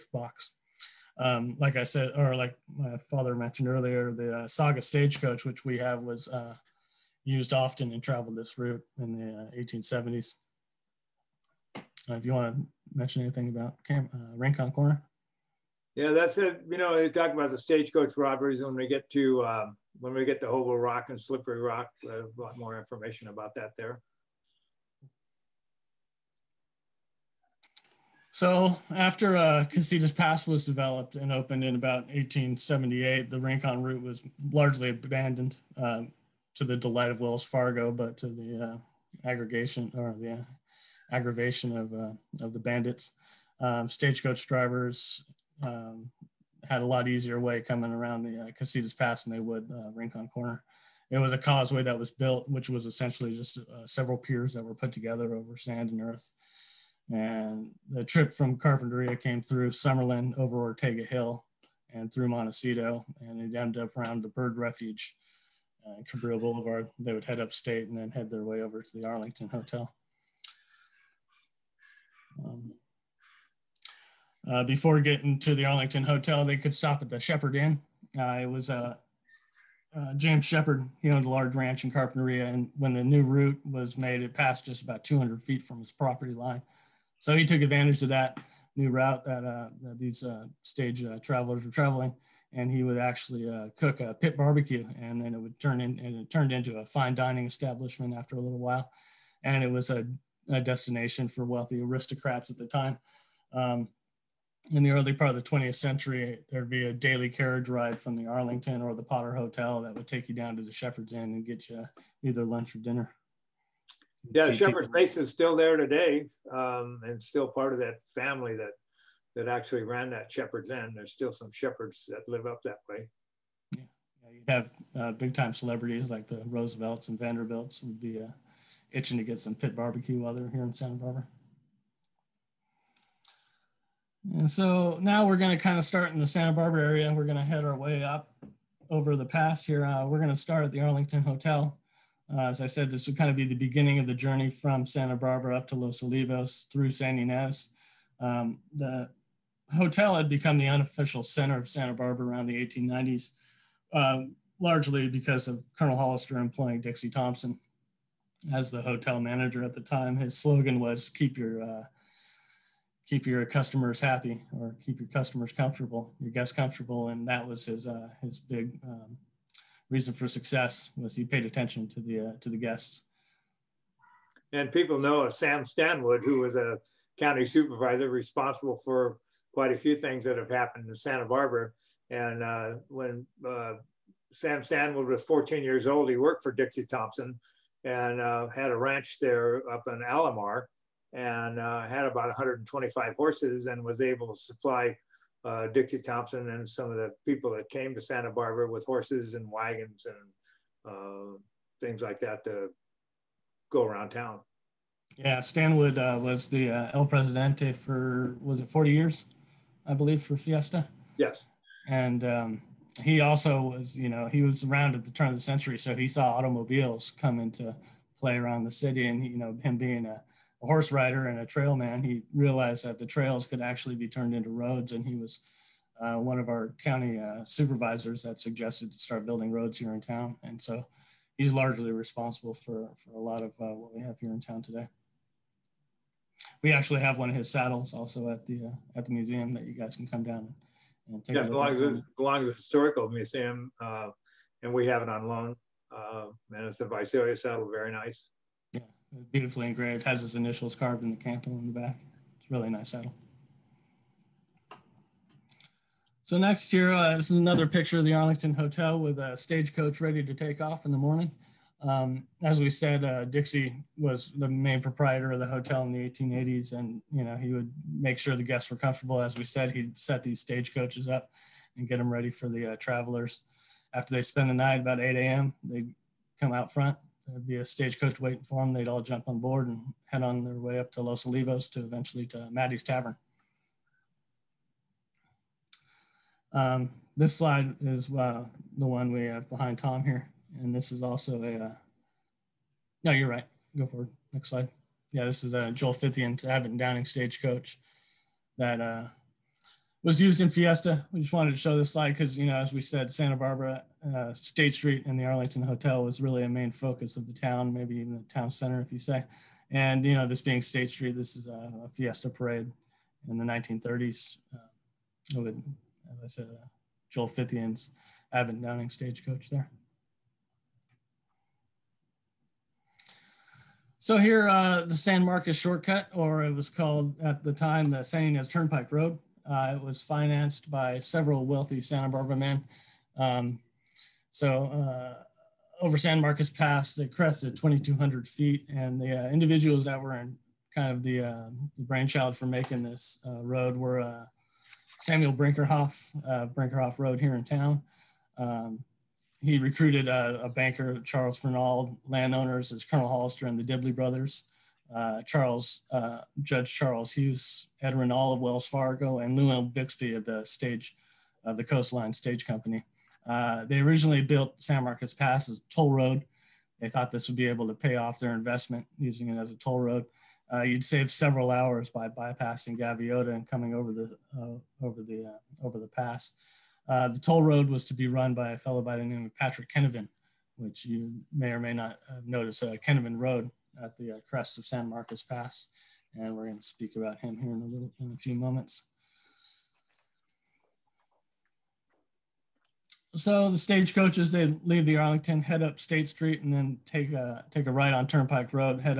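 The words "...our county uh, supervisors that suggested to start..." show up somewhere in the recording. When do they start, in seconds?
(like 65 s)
226 s.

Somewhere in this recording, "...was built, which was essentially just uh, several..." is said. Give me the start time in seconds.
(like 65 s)
51 s.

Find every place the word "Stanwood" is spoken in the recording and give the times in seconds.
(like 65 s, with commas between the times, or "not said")
175 s, 184 s, 205 s.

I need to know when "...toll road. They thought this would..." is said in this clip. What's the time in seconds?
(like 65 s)
365 s.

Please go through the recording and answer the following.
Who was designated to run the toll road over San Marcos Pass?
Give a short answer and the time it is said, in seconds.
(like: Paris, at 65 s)
Patrick Kinevan, at 379 s.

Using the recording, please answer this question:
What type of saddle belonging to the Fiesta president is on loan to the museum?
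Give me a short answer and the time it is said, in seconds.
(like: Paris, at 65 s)
Visalia saddle, at 246 s.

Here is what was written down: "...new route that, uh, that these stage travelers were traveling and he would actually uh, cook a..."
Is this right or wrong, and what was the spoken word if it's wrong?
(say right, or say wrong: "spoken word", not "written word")
right.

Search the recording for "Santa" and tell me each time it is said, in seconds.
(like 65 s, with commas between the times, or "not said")
130 s, 136 s, 144 s, 151 s, 180 s, 198 s, 303 s, 331 s.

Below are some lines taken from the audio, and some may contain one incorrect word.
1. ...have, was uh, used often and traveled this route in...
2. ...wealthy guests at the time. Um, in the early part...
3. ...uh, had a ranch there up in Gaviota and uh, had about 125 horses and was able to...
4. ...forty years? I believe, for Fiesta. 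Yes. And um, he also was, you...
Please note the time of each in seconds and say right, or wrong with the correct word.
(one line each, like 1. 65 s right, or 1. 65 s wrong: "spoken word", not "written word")
1. 5 s right
2. 101 s wrong: "aristocrats", not "guests"
3. 188 s wrong: "Alamar", not "Gaviota"
4. 208 s right.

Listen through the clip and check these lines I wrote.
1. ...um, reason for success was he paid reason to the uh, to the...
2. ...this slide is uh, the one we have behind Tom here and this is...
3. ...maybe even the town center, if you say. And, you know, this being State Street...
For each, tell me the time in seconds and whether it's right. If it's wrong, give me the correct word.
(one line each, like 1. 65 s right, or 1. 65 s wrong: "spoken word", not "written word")
1. 168 s wrong: "attention", not "reason"
2. 287 s right
3. 307 s right.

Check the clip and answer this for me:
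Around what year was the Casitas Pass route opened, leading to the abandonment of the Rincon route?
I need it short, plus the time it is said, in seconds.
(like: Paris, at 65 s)
1878, at 32 s.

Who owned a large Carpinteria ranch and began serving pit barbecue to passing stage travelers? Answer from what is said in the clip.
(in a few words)
James Shepherd.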